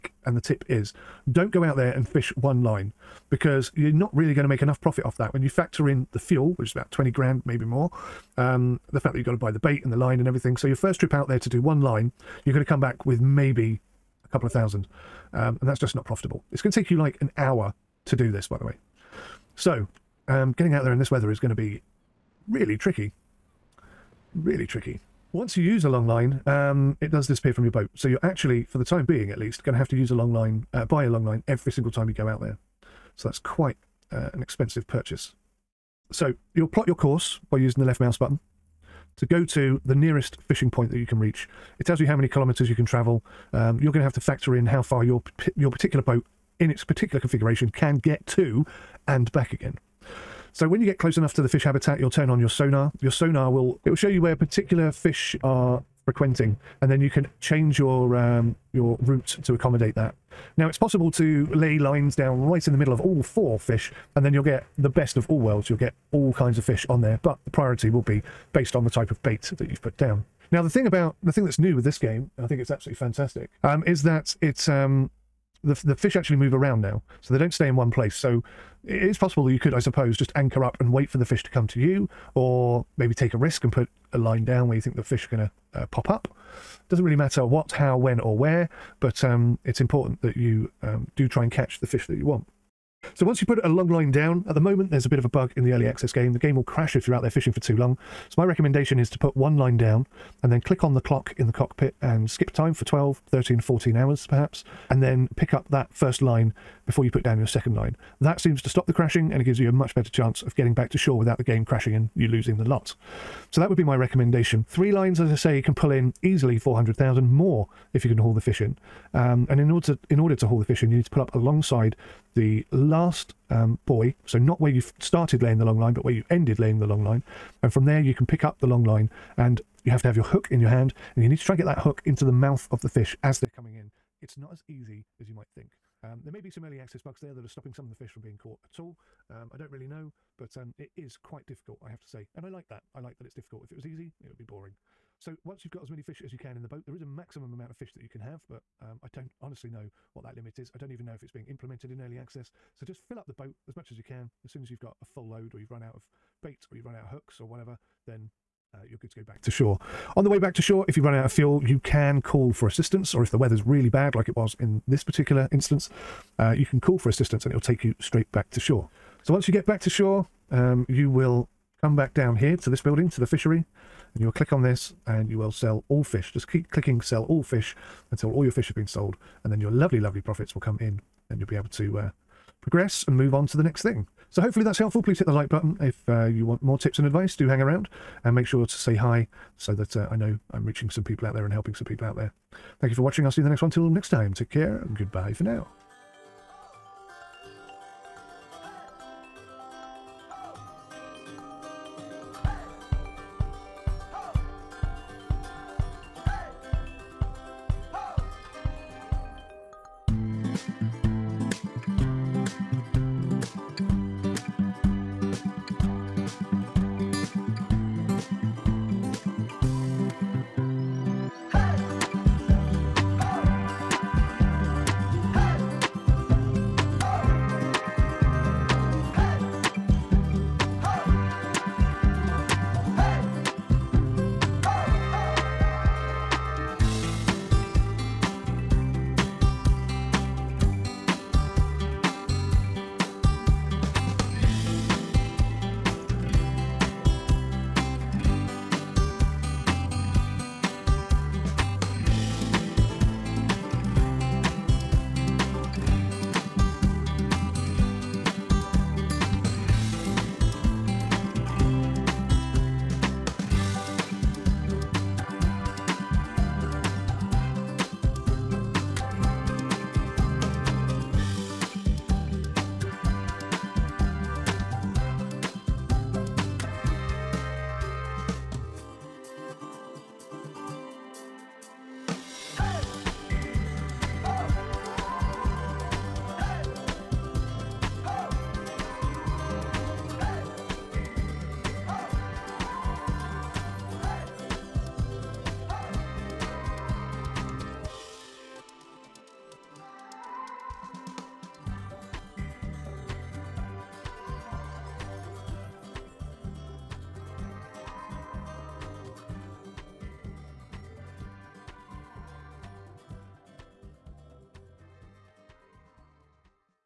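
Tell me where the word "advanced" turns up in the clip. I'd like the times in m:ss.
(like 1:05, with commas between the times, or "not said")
not said.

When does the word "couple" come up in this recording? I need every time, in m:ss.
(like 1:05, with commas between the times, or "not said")
0:14.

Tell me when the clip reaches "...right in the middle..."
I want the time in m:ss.
1:02.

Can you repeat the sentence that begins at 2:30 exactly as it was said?
I don't even know if it's being implemented in early access.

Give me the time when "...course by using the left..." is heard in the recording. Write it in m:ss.
0:36.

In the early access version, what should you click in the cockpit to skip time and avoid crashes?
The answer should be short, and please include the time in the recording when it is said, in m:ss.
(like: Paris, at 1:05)
the clock, at 1:40.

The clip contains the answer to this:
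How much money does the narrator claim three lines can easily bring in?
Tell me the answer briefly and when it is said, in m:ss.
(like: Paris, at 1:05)
400,000, at 1:56.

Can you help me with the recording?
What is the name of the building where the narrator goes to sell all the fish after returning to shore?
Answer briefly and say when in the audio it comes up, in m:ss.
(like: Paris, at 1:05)
the fishery, at 2:53.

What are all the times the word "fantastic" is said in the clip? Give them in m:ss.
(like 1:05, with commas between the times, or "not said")
1:12.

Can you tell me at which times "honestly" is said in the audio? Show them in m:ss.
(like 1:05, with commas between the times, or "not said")
2:29.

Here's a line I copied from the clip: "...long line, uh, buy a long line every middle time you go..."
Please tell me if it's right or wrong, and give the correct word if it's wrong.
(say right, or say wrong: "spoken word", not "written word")
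wrong: "single", not "middle".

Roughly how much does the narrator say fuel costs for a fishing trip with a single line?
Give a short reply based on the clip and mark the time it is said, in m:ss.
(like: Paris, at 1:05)
20 grand, at 0:06.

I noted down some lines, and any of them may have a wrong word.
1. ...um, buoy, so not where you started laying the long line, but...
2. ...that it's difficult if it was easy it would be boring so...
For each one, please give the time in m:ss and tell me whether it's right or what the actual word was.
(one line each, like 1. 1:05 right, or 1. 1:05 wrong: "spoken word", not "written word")
1. 2:03 right
2. 2:23 right.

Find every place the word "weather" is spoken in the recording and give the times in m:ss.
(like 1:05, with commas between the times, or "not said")
0:21, 2:43.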